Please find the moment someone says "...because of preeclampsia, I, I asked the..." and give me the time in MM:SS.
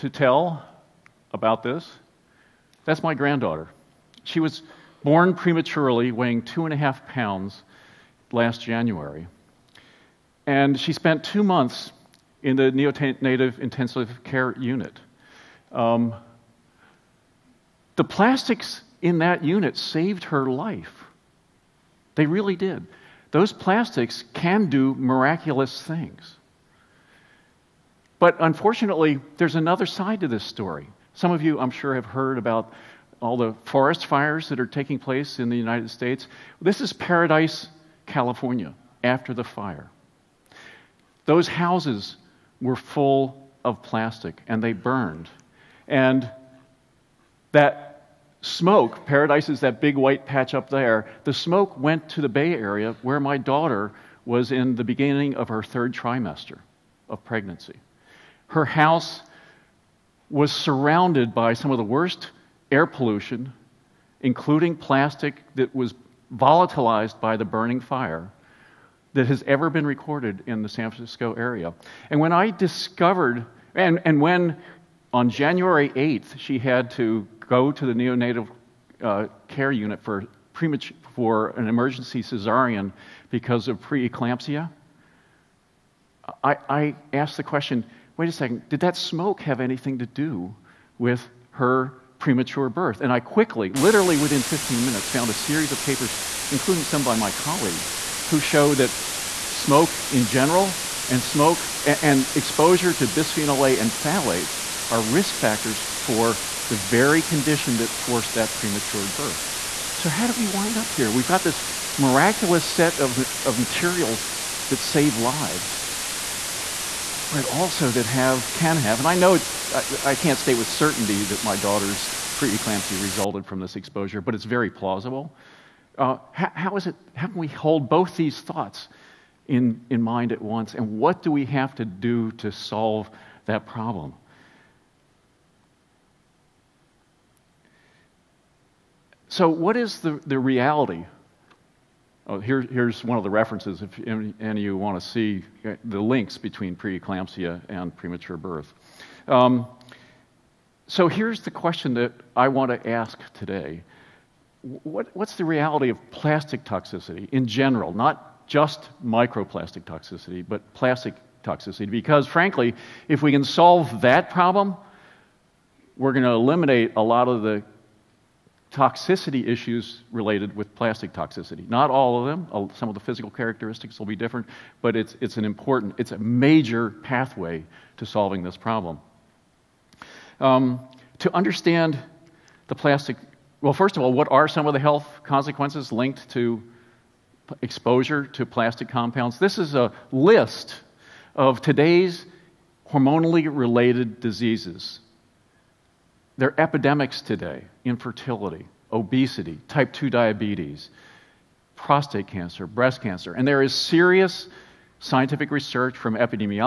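01:23.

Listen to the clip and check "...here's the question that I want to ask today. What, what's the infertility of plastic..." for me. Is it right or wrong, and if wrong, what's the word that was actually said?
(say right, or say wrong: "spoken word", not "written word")
wrong: "reality", not "infertility".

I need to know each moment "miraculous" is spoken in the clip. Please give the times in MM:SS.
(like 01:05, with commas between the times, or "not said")
00:24, 01:51.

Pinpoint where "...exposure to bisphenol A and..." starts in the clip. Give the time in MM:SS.
01:42.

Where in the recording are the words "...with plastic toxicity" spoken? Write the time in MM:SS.
02:50.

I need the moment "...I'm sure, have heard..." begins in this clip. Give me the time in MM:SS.
00:31.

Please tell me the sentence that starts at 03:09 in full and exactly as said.
This is a list of today's hormonally related diseases.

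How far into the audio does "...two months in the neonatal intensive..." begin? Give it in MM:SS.
00:11.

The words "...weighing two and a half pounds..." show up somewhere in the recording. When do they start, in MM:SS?
00:06.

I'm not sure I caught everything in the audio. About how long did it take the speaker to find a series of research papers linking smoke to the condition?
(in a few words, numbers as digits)
15 minutes.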